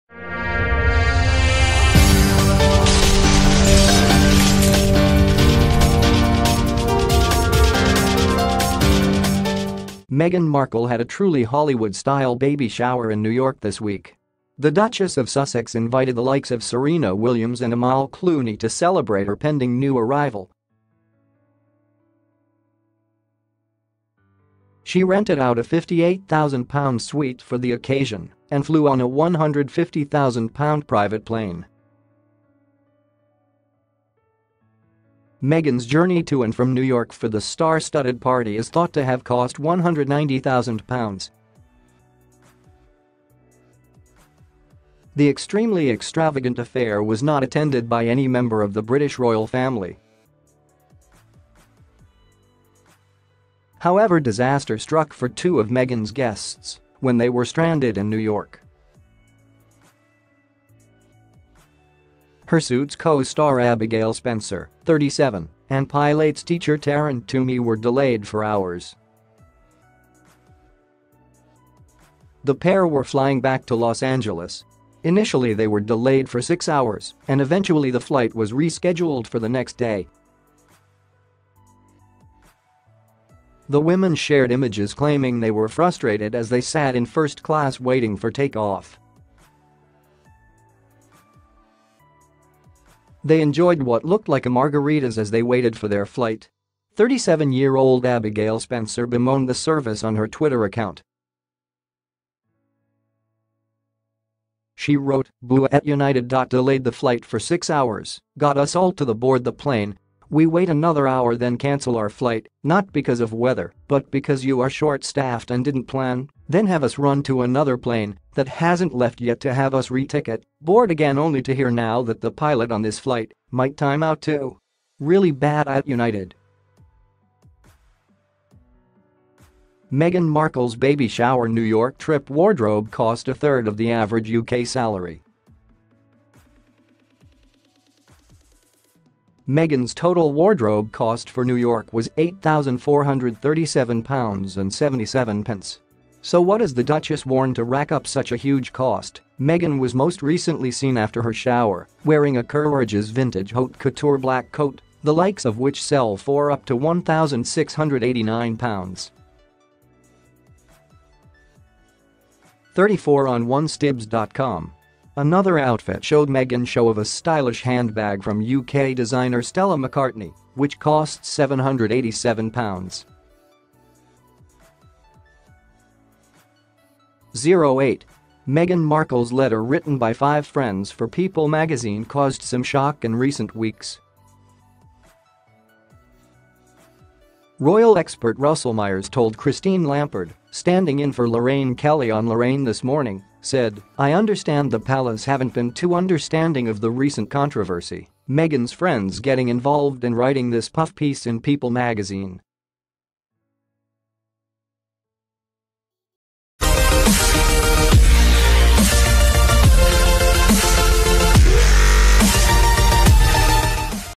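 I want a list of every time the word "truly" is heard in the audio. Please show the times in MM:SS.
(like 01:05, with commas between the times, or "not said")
00:11.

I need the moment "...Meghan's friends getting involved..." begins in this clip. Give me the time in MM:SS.
03:18.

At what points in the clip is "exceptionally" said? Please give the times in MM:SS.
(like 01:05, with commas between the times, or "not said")
not said.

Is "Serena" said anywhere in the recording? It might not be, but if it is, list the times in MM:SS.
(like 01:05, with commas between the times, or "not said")
00:16.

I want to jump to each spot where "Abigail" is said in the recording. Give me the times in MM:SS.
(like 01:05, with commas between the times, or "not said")
01:03, 01:38.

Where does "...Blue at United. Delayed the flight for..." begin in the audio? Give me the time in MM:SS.
01:45.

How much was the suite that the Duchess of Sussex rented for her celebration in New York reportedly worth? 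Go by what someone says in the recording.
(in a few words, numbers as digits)
£58,000.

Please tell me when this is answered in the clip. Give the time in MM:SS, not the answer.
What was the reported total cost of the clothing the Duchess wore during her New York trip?
02:22.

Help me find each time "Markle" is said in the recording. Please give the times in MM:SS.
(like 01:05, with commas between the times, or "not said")
00:10, 02:10, 02:58.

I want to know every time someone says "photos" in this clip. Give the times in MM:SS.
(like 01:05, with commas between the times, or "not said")
not said.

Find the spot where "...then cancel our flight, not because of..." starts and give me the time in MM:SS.
01:51.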